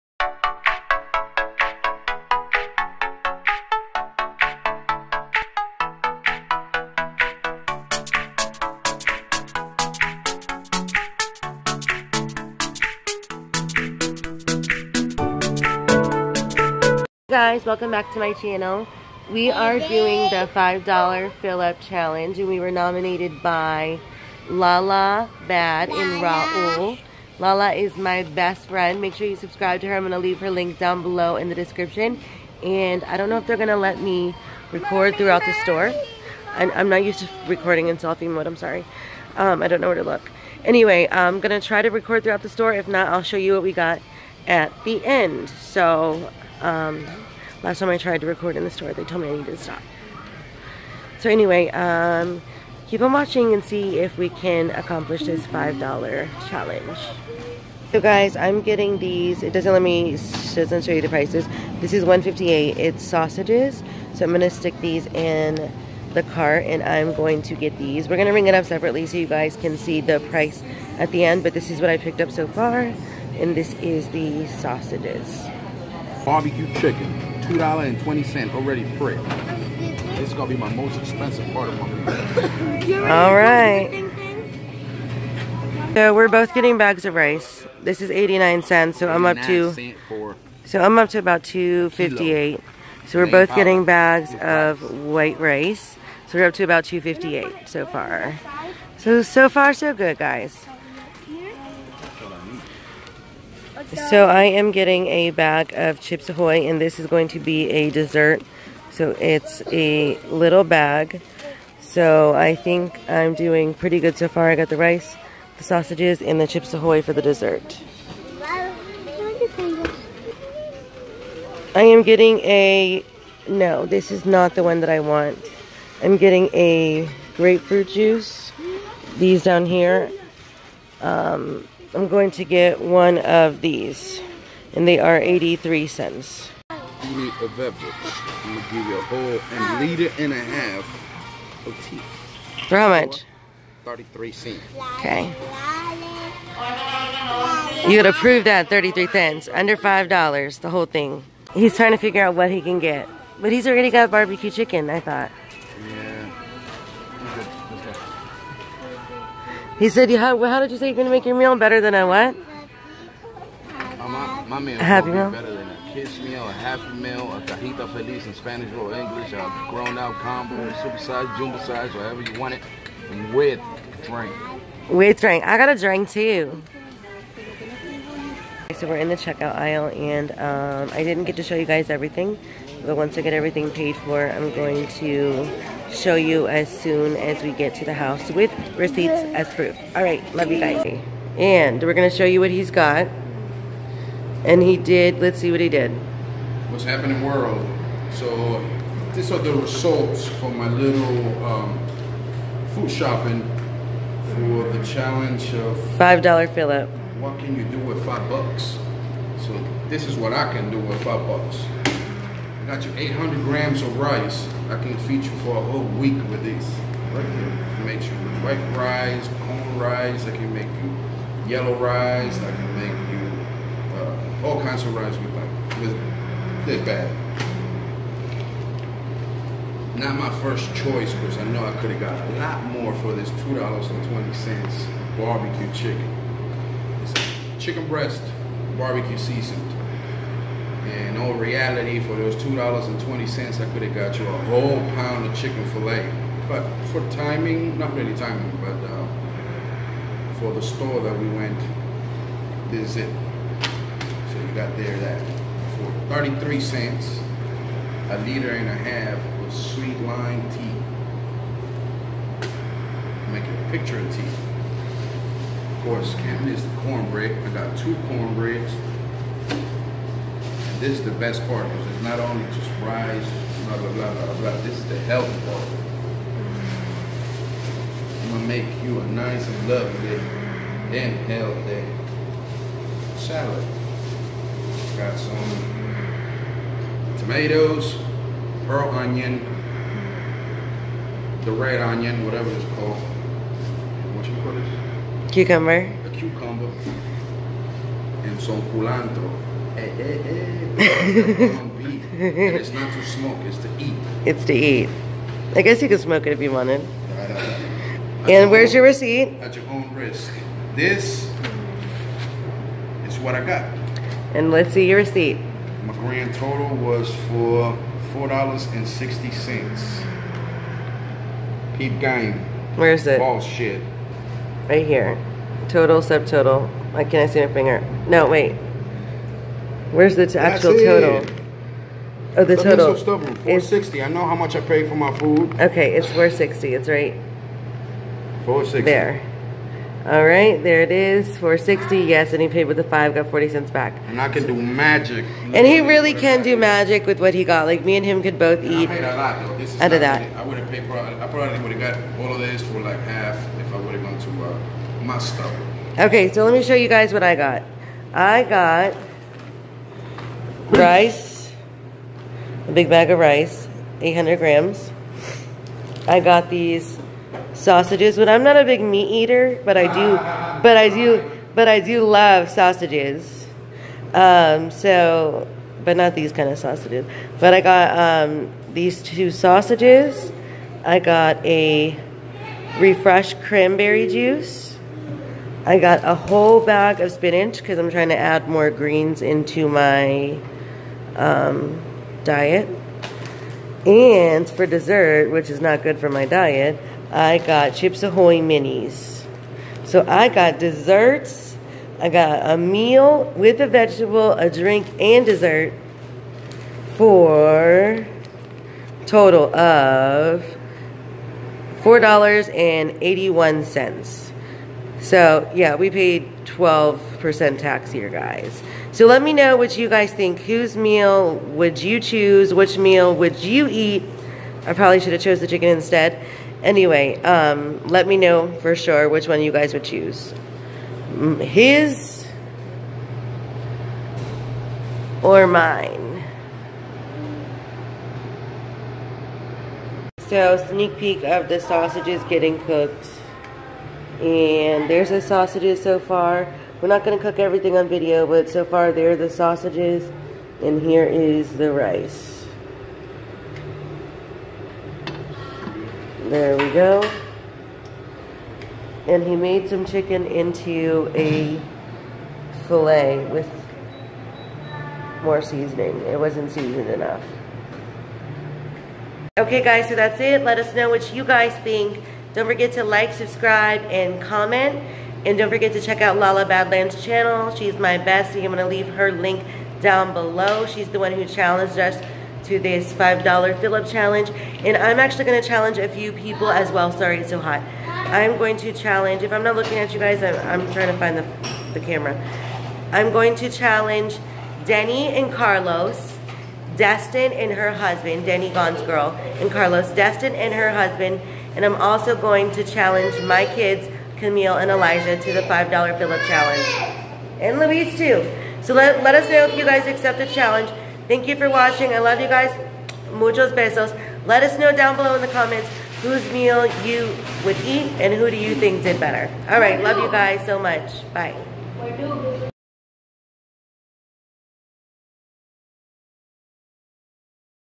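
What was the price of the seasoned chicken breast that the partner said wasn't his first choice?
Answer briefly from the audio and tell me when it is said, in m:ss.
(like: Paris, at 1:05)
$2.20, at 3:53.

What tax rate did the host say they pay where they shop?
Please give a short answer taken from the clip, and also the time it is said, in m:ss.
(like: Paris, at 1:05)
12%, at 6:56.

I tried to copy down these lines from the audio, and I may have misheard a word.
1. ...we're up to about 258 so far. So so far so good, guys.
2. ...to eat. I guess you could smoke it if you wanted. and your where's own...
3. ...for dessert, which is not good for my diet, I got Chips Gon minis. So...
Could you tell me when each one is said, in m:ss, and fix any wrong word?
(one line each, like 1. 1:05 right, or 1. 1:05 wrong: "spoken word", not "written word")
1. 1:36 right
2. 5:04 right
3. 6:34 wrong: "Ahoy", not "Gon".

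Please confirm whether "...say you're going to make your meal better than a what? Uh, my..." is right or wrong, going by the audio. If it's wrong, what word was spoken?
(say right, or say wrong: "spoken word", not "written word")
right.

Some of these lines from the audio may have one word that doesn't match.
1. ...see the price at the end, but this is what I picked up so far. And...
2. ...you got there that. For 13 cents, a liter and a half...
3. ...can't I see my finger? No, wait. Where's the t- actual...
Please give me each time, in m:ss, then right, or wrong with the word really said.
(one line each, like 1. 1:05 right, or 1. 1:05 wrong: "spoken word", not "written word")
1. 1:09 right
2. 4:14 wrong: "33", not "13"
3. 5:27 right.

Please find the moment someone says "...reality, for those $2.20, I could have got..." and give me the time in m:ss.
4:01.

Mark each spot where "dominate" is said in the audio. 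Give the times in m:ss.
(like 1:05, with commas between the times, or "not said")
not said.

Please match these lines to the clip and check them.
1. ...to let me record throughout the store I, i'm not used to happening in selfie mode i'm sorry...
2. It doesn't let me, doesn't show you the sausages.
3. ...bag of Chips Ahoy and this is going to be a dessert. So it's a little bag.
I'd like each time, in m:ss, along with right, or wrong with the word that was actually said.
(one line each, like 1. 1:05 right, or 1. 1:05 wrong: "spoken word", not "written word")
1. 0:33 wrong: "recording", not "happening"
2. 0:59 wrong: "prices", not "sausages"
3. 1:45 right.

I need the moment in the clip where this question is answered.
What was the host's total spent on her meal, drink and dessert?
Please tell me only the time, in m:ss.
6:51.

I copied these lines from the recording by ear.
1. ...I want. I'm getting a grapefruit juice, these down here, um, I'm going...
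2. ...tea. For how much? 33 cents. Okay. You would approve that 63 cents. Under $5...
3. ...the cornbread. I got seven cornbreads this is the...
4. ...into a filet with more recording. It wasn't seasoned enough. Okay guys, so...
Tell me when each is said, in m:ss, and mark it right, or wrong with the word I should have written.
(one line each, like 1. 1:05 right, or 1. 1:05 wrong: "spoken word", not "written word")
1. 2:04 right
2. 2:21 wrong: "33", not "63"
3. 4:26 wrong: "two", not "seven"
4. 7:40 wrong: "seasoning", not "recording".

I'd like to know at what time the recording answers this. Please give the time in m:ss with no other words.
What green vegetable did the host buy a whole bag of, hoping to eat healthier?
6:27.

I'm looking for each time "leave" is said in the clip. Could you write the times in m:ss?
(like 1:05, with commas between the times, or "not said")
0:30, 7:58.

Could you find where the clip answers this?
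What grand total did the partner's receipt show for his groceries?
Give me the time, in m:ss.
5:18.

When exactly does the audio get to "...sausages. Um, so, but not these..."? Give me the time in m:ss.
6:12.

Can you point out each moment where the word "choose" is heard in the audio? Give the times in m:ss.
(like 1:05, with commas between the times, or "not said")
7:02, 7:09.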